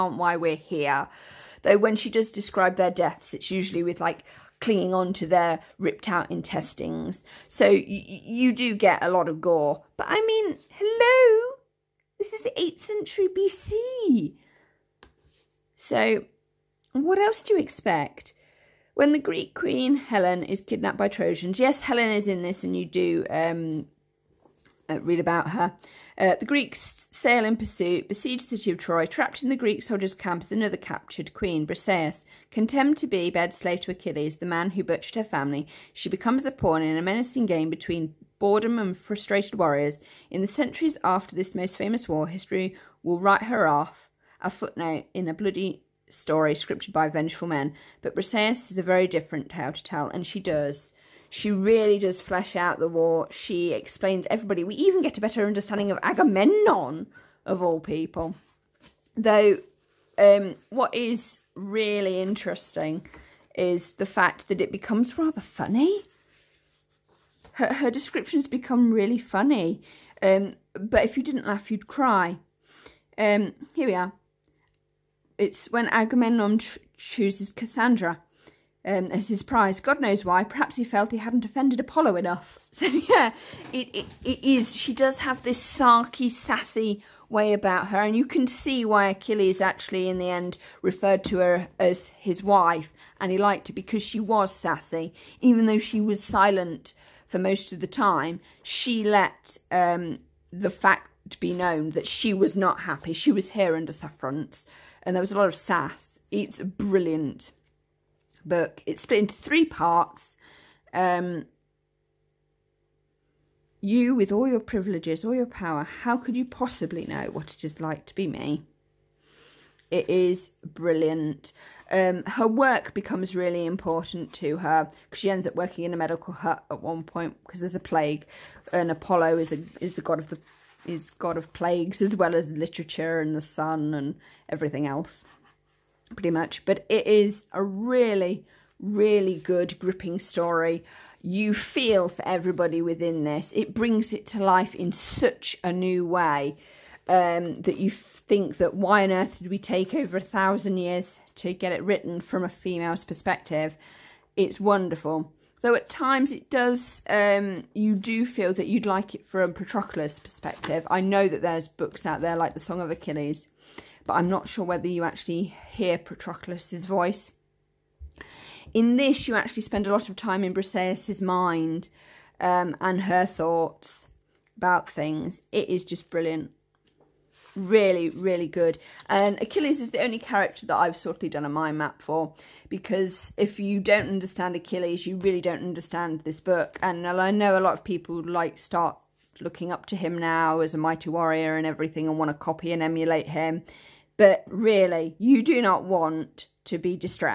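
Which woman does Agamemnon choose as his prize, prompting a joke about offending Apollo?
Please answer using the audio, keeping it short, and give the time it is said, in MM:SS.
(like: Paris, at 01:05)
Cassandra, at 01:17.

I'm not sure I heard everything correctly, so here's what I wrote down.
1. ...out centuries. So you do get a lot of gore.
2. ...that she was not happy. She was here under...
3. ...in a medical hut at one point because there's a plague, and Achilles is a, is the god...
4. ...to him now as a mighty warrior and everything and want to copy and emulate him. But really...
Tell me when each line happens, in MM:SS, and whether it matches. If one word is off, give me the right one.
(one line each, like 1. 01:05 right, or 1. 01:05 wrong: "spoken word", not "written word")
1. 00:06 wrong: "intestines", not "centuries"
2. 01:41 right
3. 02:05 wrong: "Apollo", not "Achilles"
4. 03:09 right.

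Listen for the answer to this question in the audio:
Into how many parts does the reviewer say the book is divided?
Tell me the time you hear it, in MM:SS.
01:49.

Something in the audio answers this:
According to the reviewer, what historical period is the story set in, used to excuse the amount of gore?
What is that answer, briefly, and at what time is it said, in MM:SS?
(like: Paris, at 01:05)
8th century BC, at 00:12.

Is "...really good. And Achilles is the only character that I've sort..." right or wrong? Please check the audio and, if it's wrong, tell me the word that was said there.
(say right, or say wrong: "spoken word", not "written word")
right.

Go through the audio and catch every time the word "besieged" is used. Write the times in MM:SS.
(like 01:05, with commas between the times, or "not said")
00:28.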